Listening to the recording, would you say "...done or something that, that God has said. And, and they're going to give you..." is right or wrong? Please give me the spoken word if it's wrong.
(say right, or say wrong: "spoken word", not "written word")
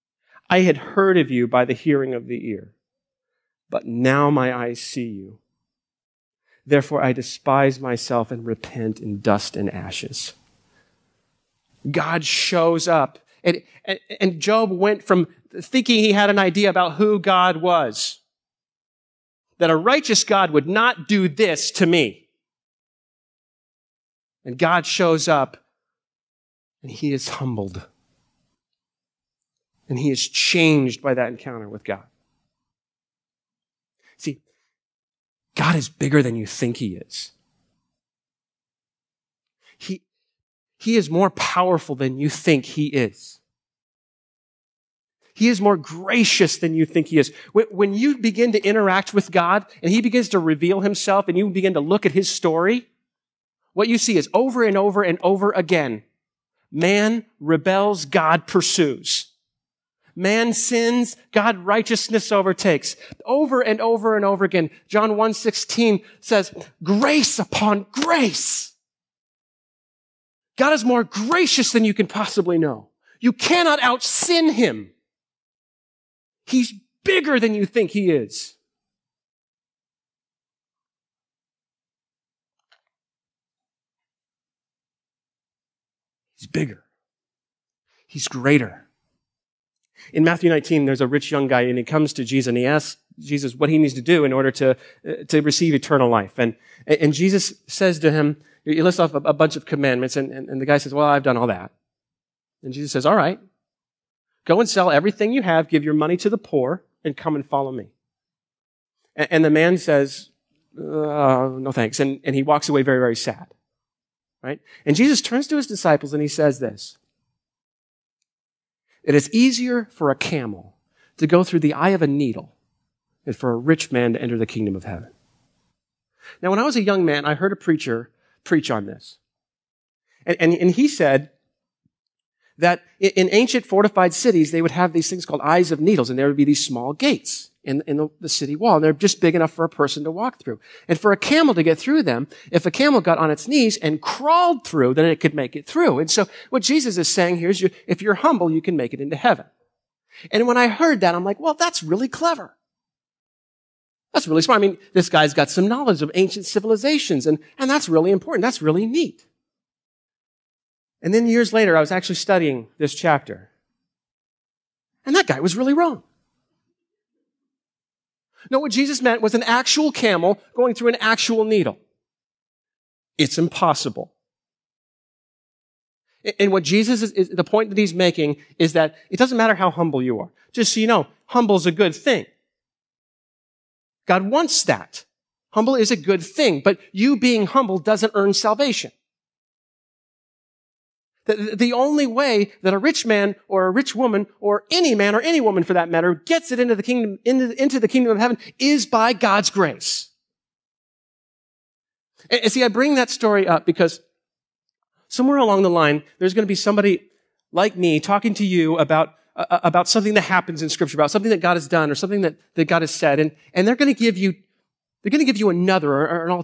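right.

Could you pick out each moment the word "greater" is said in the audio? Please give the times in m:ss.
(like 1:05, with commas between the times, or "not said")
1:28.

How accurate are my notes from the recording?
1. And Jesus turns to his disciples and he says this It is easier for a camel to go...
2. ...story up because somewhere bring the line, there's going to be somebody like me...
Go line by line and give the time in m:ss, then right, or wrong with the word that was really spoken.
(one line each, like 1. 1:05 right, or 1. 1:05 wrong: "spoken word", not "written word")
1. 1:54 right
2. 3:23 wrong: "along", not "bring".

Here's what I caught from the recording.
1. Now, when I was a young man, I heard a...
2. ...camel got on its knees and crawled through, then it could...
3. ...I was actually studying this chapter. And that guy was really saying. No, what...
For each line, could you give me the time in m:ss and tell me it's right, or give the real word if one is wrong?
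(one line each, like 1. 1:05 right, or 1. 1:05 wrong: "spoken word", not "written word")
1. 2:06 right
2. 2:22 right
3. 2:41 wrong: "wrong", not "saying".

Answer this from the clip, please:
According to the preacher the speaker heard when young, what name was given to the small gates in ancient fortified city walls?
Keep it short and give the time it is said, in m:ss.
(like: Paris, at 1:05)
eyes of needles, at 2:15.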